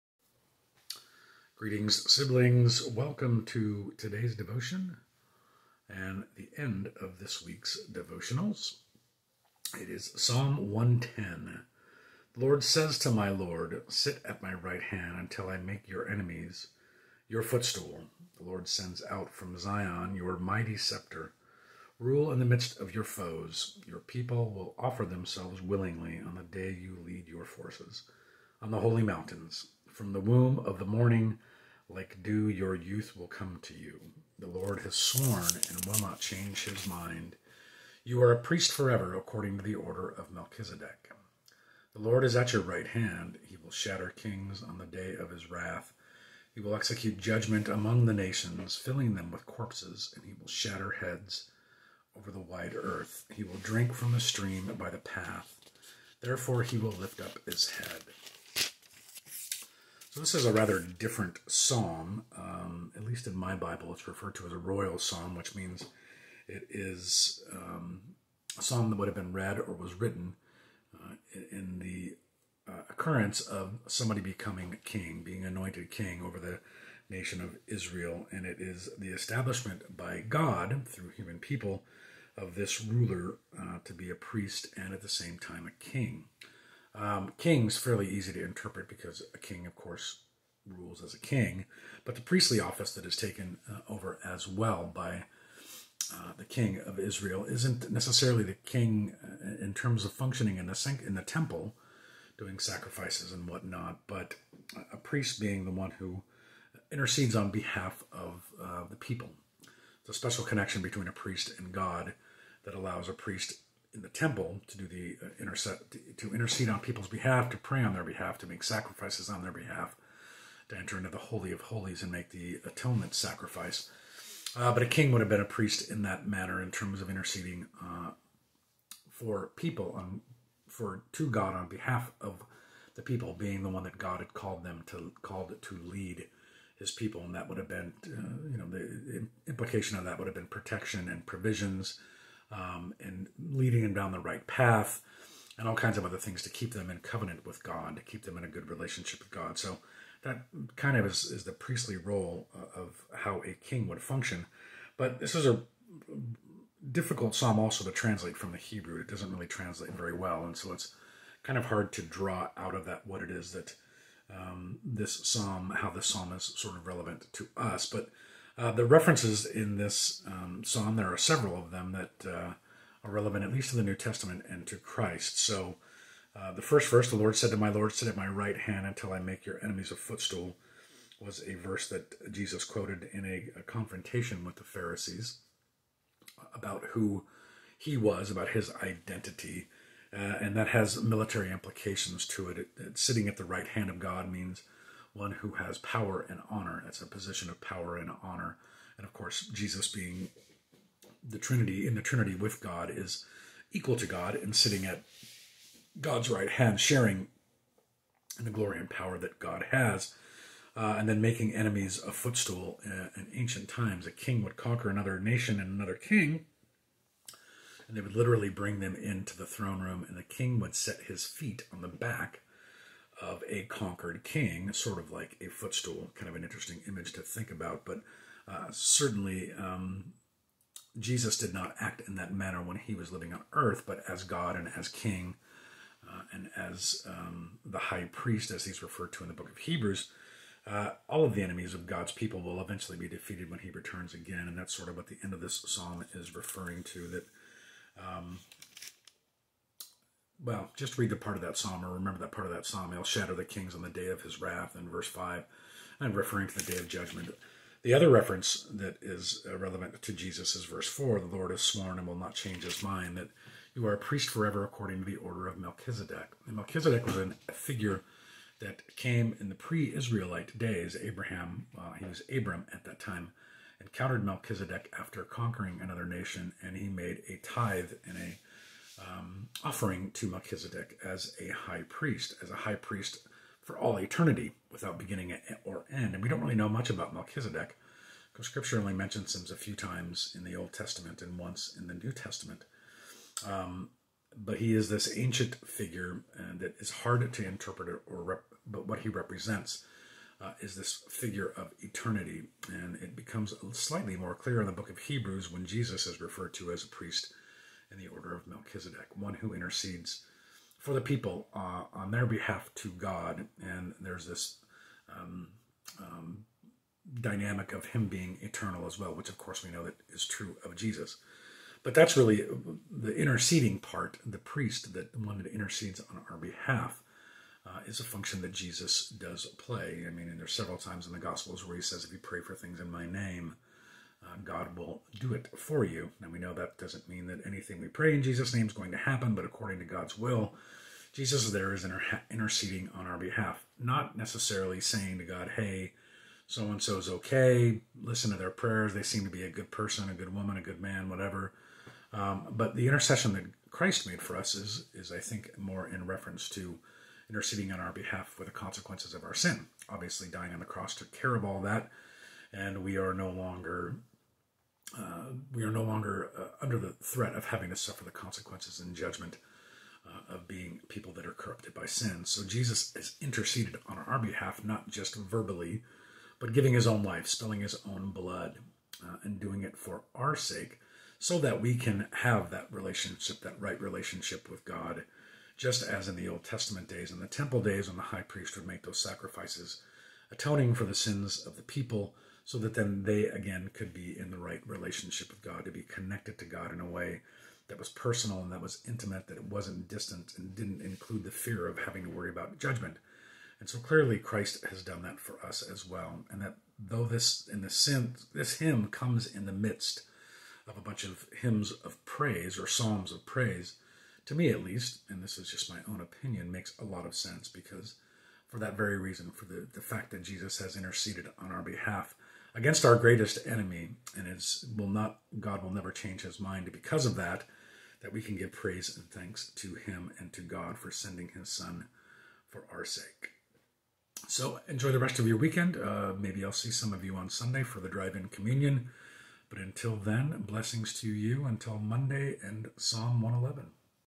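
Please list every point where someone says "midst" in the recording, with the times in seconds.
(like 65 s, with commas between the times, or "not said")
22 s, 409 s.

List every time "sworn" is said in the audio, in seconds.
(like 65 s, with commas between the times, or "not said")
34 s, 261 s.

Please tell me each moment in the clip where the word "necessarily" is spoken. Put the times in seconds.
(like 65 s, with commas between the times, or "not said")
97 s, 344 s.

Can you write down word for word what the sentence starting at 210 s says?
Uh, and then making enemies a footstool uh, in ancient times.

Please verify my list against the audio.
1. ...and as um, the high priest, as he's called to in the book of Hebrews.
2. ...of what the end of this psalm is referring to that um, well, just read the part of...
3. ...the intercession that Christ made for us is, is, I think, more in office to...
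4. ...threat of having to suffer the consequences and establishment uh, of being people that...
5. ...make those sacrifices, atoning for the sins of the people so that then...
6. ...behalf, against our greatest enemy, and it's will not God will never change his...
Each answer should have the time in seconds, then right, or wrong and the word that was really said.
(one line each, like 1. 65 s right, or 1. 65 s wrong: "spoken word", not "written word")
1. 236 s wrong: "referred", not "called"
2. 244 s right
3. 352 s wrong: "reference", not "office"
4. 367 s wrong: "judgment", not "establishment"
5. 388 s right
6. 421 s right.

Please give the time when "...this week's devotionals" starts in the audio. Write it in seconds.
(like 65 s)
7 s.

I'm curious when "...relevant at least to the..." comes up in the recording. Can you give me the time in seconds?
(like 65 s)
173 s.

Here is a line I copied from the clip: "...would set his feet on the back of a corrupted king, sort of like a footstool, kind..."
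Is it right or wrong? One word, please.
wrong.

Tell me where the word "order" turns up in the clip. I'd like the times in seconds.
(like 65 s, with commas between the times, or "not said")
39 s, 265 s, 308 s.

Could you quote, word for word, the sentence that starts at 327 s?
Uh, is a function that Jesus does play.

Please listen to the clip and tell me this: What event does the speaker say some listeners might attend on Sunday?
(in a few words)
drive-in communion.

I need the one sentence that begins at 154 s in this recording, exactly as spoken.
But this is a difficult psalm also to translate from the Hebrew.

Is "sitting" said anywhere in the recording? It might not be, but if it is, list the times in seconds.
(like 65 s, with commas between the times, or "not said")
192 s, 204 s.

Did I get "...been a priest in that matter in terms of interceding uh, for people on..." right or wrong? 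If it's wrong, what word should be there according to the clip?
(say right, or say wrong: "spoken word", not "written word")
right.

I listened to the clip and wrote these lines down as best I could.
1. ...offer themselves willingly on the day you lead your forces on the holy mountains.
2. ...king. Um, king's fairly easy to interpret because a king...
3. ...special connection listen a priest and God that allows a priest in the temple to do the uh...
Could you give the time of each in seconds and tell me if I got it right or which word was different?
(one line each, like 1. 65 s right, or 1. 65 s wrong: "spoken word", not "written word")
1. 24 s right
2. 85 s right
3. 110 s wrong: "between", not "listen".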